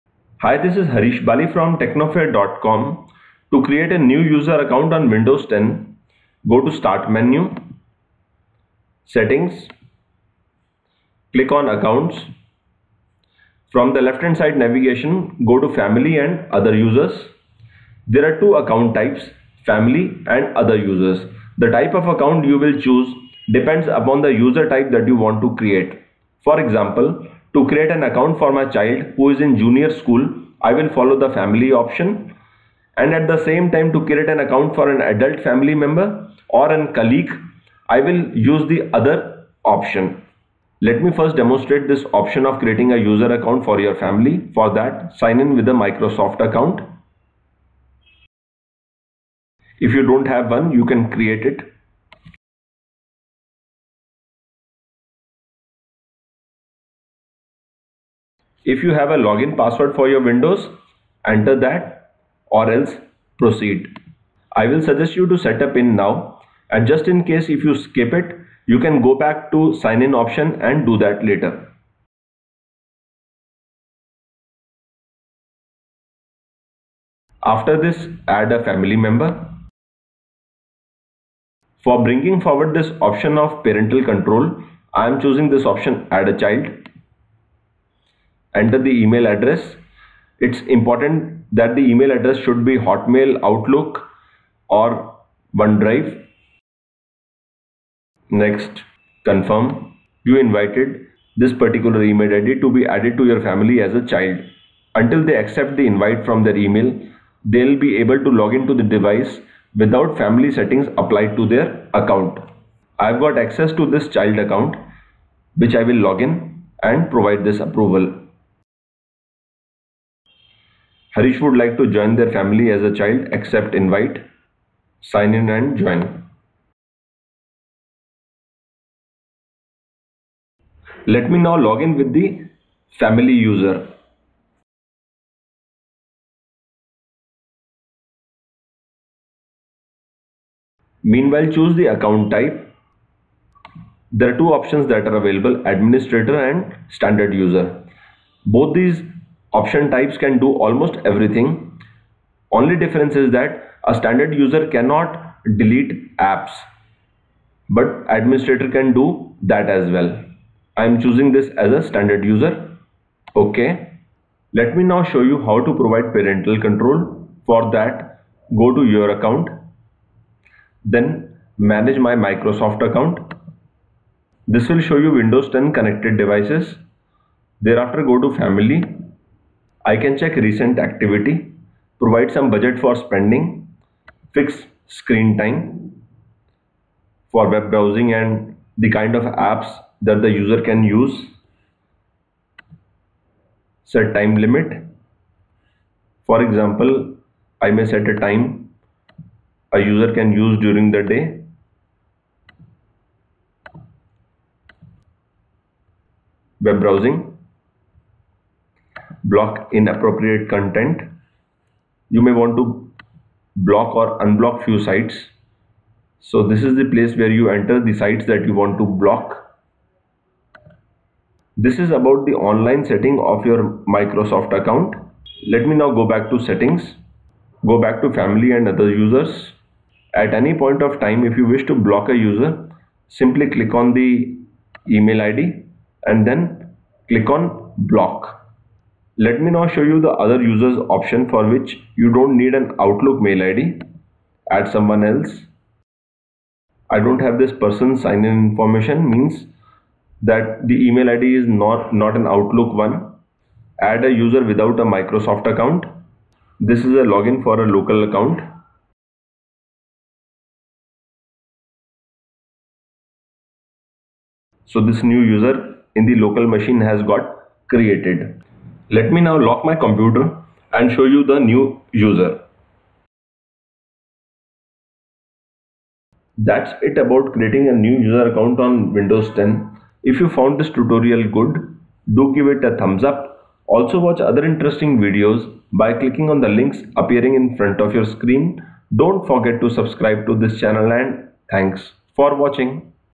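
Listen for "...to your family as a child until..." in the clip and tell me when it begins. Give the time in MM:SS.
01:43.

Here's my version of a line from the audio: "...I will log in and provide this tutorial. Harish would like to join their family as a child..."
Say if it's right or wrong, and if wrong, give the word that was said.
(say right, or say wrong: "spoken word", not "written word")
wrong: "approval", not "tutorial".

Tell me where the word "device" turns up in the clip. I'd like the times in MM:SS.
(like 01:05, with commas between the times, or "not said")
01:48, 02:56.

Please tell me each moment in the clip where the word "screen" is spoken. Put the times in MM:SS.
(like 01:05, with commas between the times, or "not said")
03:04, 04:48.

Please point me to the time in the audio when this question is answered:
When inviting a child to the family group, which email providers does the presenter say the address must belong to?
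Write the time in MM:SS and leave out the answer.
01:32.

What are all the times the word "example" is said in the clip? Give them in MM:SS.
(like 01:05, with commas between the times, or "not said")
00:26, 03:16.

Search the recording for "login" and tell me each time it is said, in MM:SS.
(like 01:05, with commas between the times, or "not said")
00:59, 04:17.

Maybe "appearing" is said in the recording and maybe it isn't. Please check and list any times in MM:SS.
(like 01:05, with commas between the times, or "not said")
04:46.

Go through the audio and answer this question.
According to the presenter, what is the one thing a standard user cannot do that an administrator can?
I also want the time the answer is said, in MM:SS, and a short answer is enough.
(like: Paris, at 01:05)
Delete apps, at 02:35.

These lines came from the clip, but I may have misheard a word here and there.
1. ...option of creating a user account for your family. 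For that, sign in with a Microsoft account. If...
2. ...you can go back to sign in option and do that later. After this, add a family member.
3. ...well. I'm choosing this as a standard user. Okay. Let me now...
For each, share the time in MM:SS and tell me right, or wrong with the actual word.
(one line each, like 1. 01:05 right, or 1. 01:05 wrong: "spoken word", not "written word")
1. 00:42 right
2. 01:08 right
3. 02:39 right.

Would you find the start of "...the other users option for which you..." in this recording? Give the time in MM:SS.
03:59.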